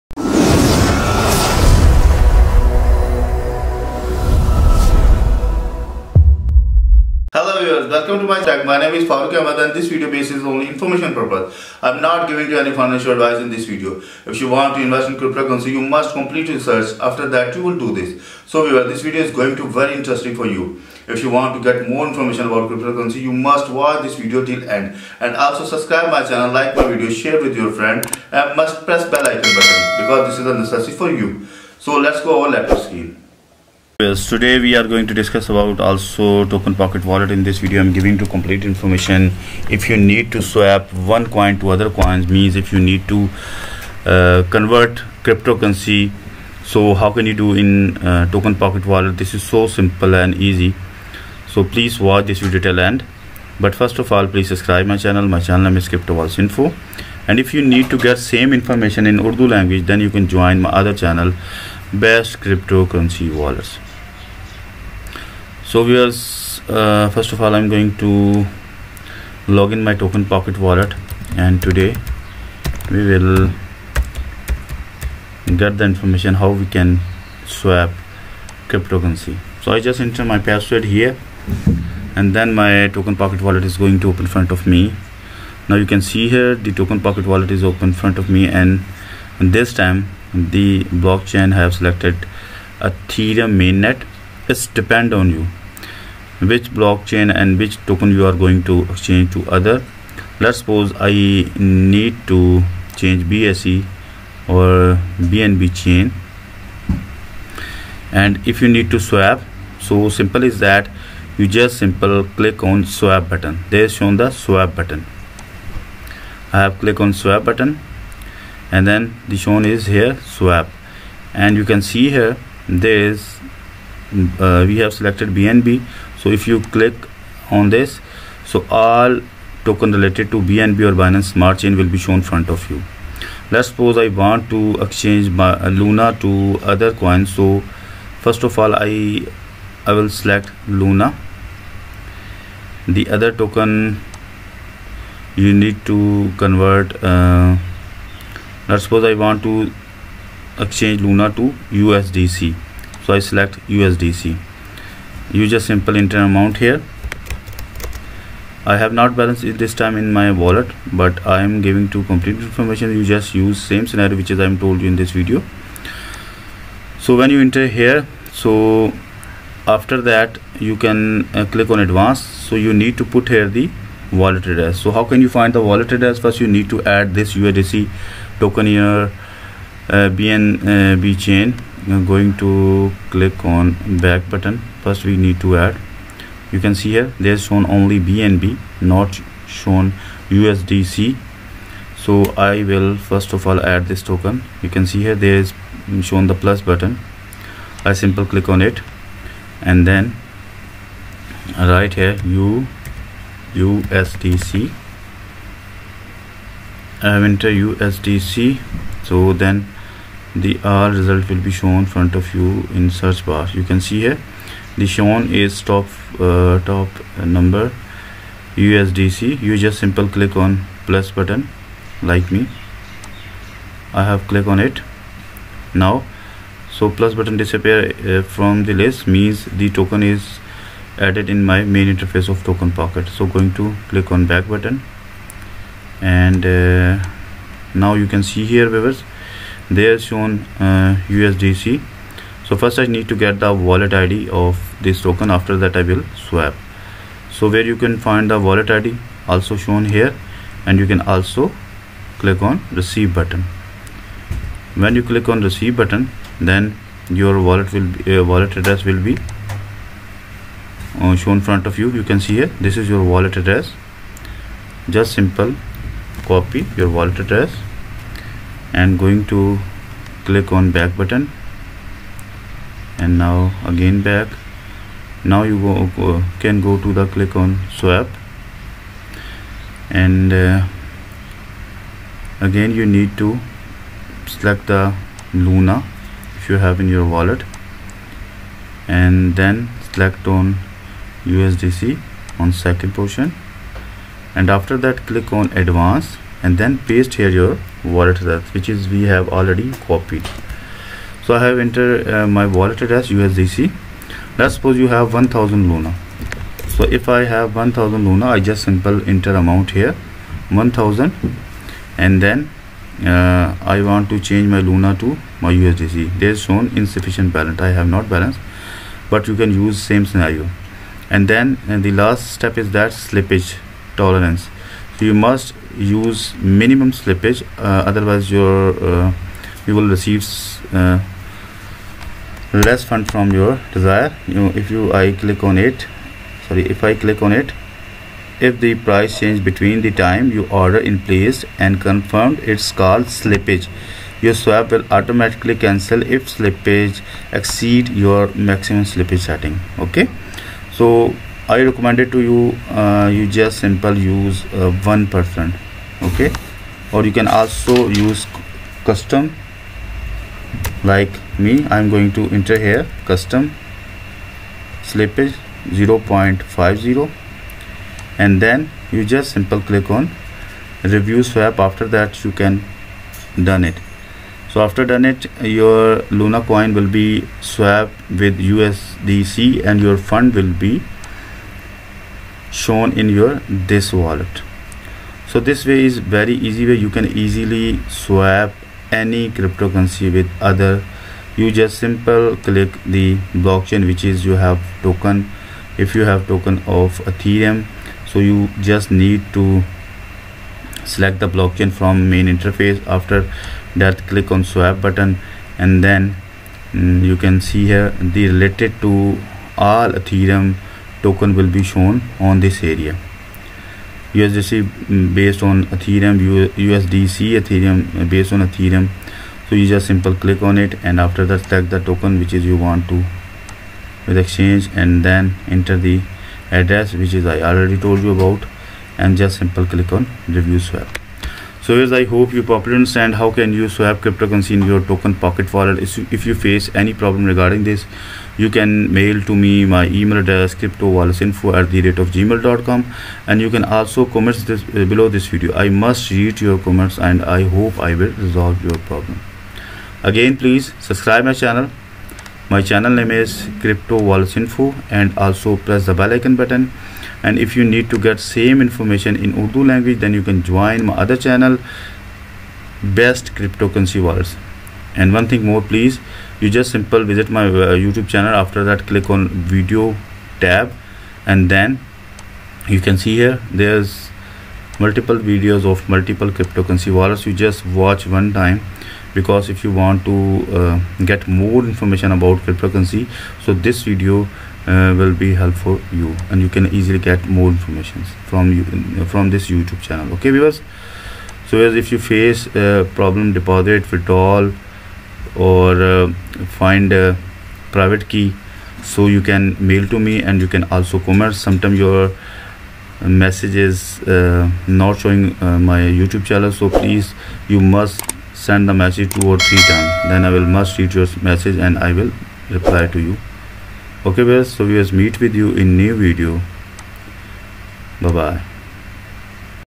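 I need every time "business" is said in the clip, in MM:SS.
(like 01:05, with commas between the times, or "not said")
not said.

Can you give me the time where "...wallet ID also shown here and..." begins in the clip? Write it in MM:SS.
04:08.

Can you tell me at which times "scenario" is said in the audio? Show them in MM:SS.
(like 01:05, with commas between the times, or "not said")
02:43, 05:20.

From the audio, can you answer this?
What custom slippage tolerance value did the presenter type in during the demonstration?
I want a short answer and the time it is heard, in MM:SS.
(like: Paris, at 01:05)
0.50, at 06:05.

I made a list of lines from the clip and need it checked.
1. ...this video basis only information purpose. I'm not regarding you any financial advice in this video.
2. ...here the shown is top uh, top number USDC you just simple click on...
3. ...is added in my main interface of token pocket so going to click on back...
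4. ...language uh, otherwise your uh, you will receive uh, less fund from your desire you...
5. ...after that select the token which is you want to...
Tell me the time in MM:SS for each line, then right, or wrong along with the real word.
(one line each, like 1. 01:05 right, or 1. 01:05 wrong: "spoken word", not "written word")
1. 00:09 wrong: "giving", not "regarding"
2. 03:34 right
3. 03:50 right
4. 05:26 wrong: "slippage", not "language"
5. 07:00 right.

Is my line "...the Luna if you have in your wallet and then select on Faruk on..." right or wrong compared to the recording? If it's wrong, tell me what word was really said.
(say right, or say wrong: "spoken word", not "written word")
wrong: "USDC", not "Faruk".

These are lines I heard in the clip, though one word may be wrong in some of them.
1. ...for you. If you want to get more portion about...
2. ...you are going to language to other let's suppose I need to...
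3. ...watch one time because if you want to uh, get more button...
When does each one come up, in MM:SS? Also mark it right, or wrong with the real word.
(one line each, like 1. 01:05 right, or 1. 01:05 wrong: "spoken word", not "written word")
1. 00:20 wrong: "information", not "portion"
2. 01:38 wrong: "exchange", not "language"
3. 07:57 wrong: "information", not "button".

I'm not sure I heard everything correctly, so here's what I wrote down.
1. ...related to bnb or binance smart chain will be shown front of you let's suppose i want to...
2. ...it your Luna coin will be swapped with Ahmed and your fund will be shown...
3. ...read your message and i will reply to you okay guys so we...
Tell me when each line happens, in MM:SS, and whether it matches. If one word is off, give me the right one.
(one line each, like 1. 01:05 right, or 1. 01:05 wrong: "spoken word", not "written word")
1. 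02:09 right
2. 06:15 wrong: "USDC", not "Ahmed"
3. 08:30 right.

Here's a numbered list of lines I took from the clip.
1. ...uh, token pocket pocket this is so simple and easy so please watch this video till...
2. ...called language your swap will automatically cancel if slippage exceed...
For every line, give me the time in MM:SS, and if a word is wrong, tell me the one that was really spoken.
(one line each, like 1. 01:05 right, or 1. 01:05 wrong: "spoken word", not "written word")
1. 00:48 wrong: "wallet", not "pocket"
2. 05:42 wrong: "slippage", not "language".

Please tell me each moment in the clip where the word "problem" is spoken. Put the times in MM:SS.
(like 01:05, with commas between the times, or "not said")
07:16, 07:28, 08:12.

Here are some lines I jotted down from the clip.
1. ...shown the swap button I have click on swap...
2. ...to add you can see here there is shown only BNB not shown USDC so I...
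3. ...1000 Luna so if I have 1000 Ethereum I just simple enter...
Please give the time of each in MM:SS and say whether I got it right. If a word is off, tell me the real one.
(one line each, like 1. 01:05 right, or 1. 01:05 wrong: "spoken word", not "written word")
1. 01:53 right
2. 03:05 right
3. 05:05 wrong: "Luna", not "Ethereum".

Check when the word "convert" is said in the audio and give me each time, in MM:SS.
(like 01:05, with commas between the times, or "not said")
00:44, 02:26.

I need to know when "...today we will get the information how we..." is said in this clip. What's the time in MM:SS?
01:11.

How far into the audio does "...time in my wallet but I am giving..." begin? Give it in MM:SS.
02:39.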